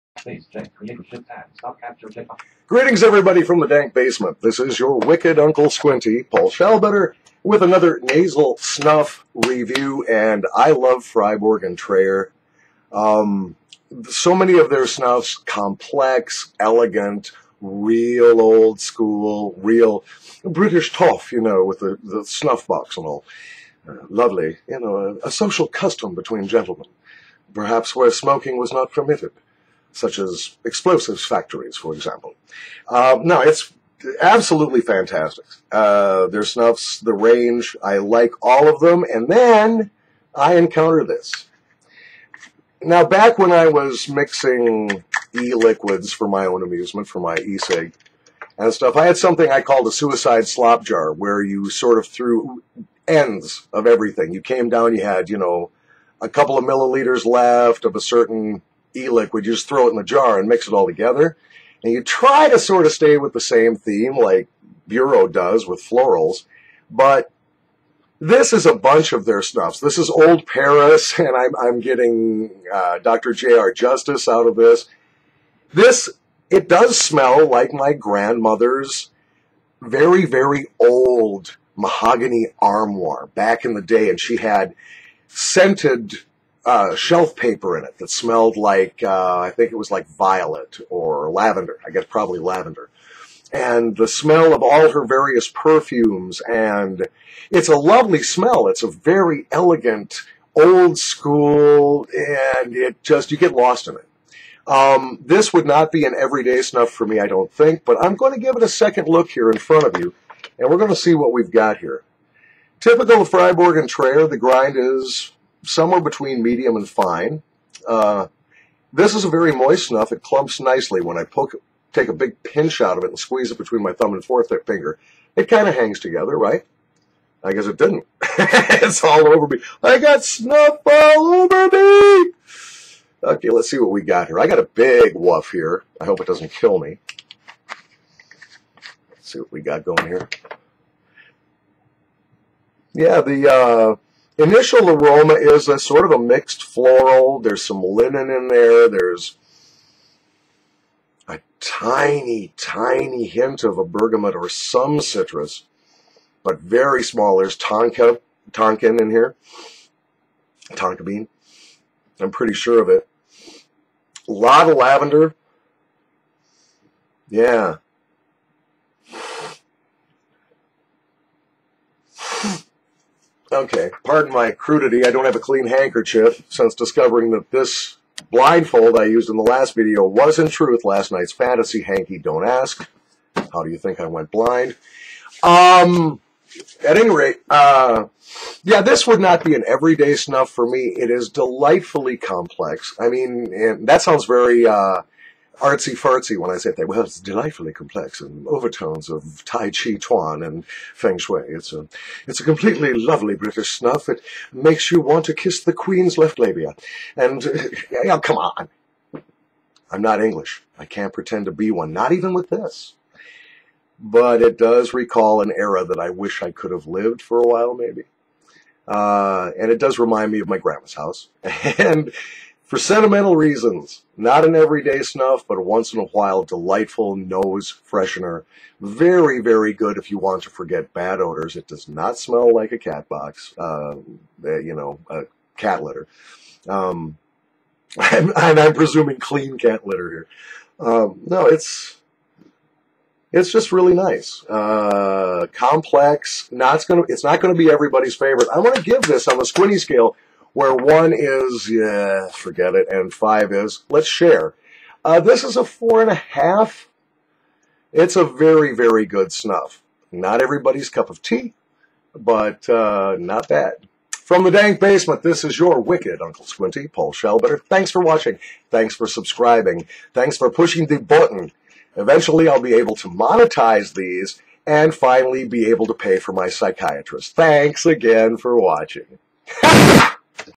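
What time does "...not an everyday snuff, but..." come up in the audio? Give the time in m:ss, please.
3:44.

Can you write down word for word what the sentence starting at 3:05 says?
Um, at any rate, uh, yeah, this would not be an everyday snuff for me.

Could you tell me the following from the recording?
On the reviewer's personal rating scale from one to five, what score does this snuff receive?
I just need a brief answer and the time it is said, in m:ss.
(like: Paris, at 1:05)
4.5, at 4:15.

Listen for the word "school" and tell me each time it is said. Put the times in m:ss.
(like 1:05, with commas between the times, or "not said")
0:18, 1:40.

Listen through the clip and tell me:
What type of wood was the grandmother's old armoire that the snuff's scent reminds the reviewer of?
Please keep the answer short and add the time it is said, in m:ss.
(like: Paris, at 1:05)
Mahogany, at 1:21.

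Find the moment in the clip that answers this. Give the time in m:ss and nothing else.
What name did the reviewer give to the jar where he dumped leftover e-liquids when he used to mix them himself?
0:49.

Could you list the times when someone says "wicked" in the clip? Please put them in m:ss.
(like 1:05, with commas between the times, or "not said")
0:04, 4:25.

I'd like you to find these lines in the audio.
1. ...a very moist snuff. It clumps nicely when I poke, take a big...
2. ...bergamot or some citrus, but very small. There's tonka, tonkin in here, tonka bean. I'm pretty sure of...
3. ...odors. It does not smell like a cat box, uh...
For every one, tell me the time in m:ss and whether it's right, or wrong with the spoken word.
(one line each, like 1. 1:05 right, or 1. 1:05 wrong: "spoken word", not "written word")
1. 1:59 right
2. 2:33 right
3. 3:51 right.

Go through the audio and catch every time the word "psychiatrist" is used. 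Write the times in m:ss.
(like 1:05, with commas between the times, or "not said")
4:36.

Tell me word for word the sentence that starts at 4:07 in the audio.
It's not gonna be everybody's favorite.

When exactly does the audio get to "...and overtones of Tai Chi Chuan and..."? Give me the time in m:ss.
3:18.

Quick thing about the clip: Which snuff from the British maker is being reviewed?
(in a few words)
Old Paris.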